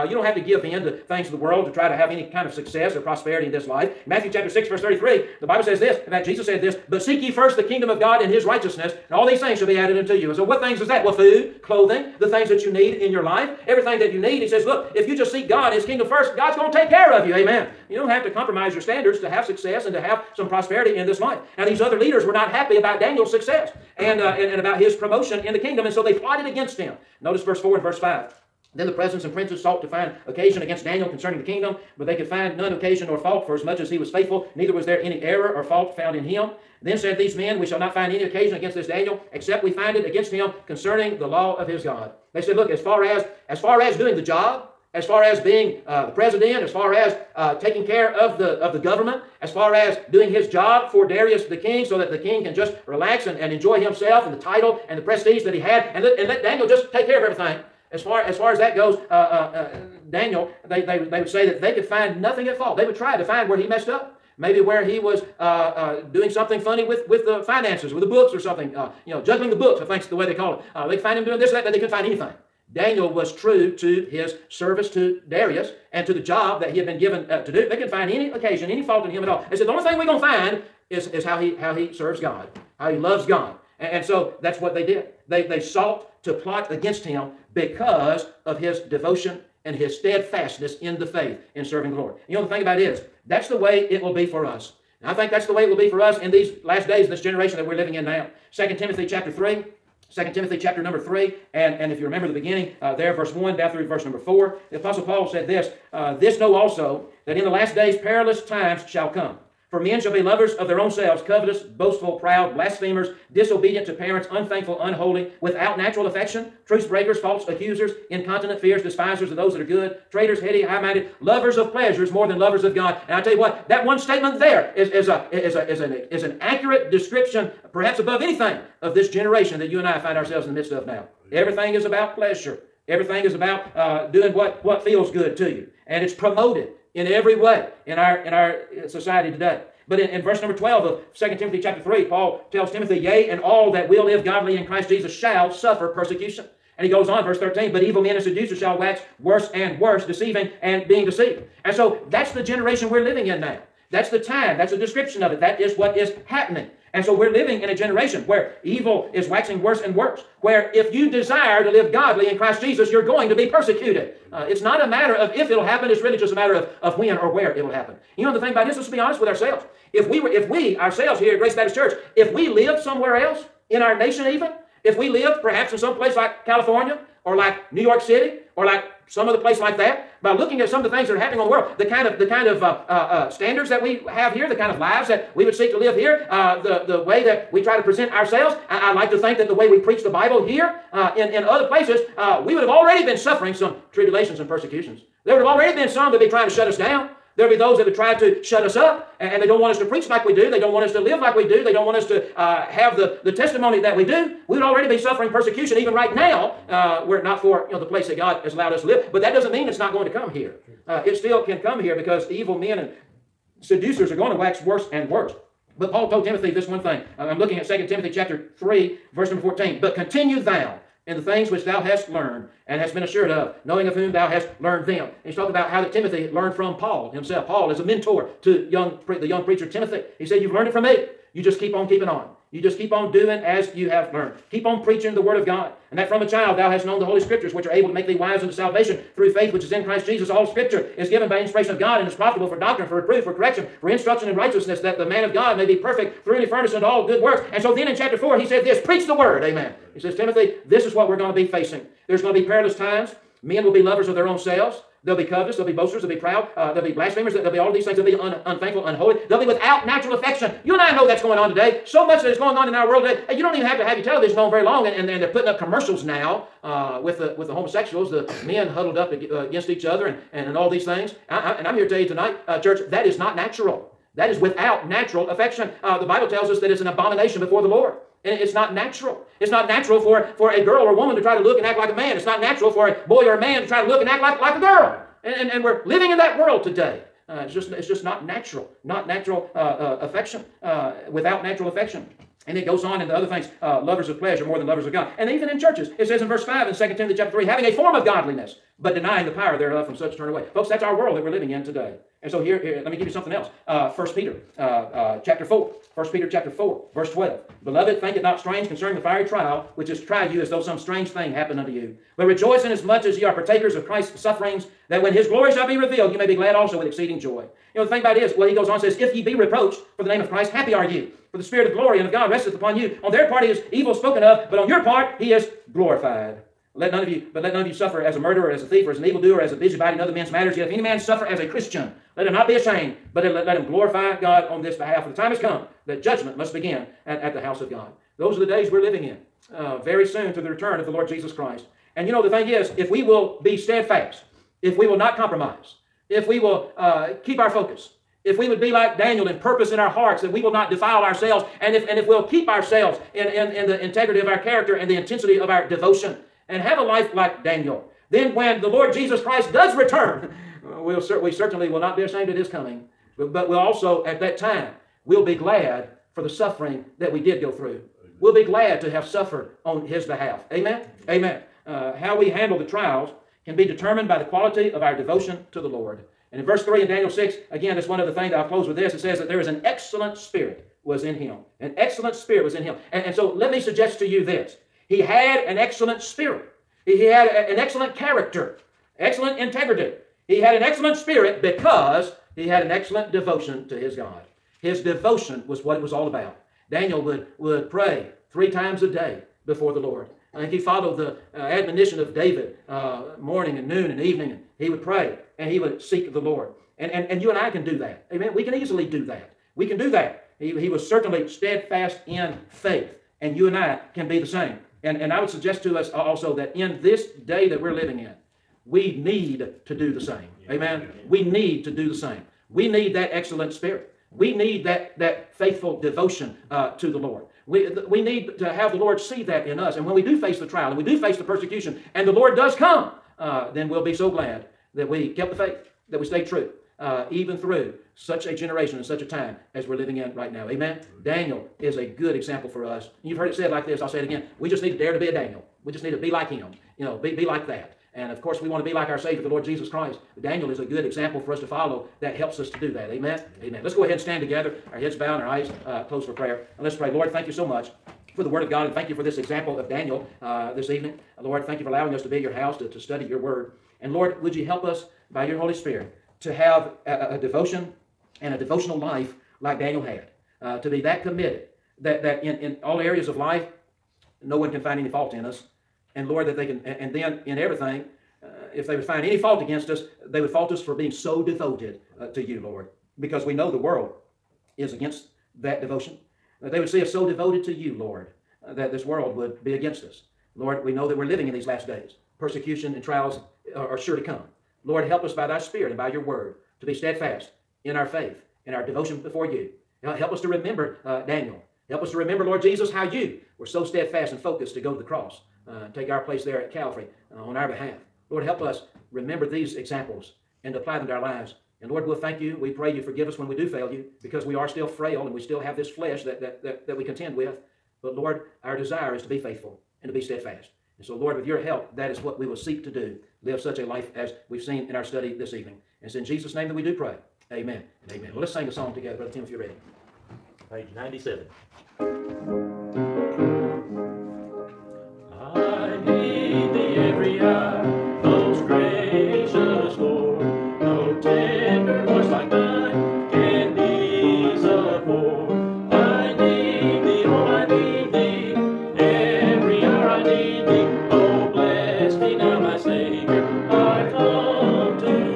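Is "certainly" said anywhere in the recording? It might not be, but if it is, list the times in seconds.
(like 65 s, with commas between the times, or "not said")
361 s, 410 s.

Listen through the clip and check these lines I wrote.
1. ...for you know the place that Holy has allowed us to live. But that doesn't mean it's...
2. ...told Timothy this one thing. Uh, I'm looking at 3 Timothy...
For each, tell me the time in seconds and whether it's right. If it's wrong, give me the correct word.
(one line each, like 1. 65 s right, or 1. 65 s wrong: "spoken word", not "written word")
1. 207 s wrong: "God", not "Holy"
2. 216 s wrong: "2", not "3".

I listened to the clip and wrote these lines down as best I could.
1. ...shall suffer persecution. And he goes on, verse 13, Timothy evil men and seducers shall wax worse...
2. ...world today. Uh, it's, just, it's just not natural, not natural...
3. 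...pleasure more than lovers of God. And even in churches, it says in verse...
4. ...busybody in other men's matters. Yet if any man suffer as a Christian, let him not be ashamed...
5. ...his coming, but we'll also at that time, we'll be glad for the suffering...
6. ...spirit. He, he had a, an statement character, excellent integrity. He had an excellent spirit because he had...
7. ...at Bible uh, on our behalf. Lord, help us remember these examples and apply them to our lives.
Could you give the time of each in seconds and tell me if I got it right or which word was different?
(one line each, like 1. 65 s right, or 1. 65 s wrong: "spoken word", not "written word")
1. 145 s wrong: "But", not "Timothy"
2. 286 s right
3. 294 s right
4. 329 s right
5. 362 s right
6. 386 s wrong: "excellent", not "statement"
7. 506 s wrong: "Calvary", not "Bible".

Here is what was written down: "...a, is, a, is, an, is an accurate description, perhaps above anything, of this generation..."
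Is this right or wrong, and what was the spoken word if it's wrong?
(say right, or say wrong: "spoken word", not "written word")
right.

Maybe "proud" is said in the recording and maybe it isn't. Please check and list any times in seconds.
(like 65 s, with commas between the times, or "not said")
112 s, 256 s.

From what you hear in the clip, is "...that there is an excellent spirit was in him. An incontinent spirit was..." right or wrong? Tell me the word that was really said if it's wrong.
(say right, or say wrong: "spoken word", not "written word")
wrong: "excellent", not "incontinent".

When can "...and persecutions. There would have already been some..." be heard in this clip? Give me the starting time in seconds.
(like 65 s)
194 s.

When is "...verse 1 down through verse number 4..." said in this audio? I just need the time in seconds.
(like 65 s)
103 s.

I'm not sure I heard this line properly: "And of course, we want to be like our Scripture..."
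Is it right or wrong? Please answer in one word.
wrong.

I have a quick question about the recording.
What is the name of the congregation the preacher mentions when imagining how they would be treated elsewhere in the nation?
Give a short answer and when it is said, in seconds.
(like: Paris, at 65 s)
Grace Baptist Church, at 171 s.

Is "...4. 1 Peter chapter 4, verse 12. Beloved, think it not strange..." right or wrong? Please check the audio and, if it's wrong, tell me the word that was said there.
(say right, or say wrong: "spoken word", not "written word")
right.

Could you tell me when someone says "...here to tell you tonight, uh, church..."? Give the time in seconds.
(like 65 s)
271 s.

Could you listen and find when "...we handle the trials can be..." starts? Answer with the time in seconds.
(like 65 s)
372 s.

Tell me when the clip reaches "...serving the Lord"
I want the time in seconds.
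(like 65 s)
91 s.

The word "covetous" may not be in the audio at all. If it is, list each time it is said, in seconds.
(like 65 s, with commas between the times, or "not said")
111 s, 255 s.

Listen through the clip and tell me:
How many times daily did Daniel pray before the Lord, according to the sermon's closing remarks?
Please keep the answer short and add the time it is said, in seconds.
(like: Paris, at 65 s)
3, at 398 s.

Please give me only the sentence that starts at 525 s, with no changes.
And it's in Jesus' name that we do pray.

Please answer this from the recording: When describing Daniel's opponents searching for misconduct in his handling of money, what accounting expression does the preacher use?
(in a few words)
juggling the books.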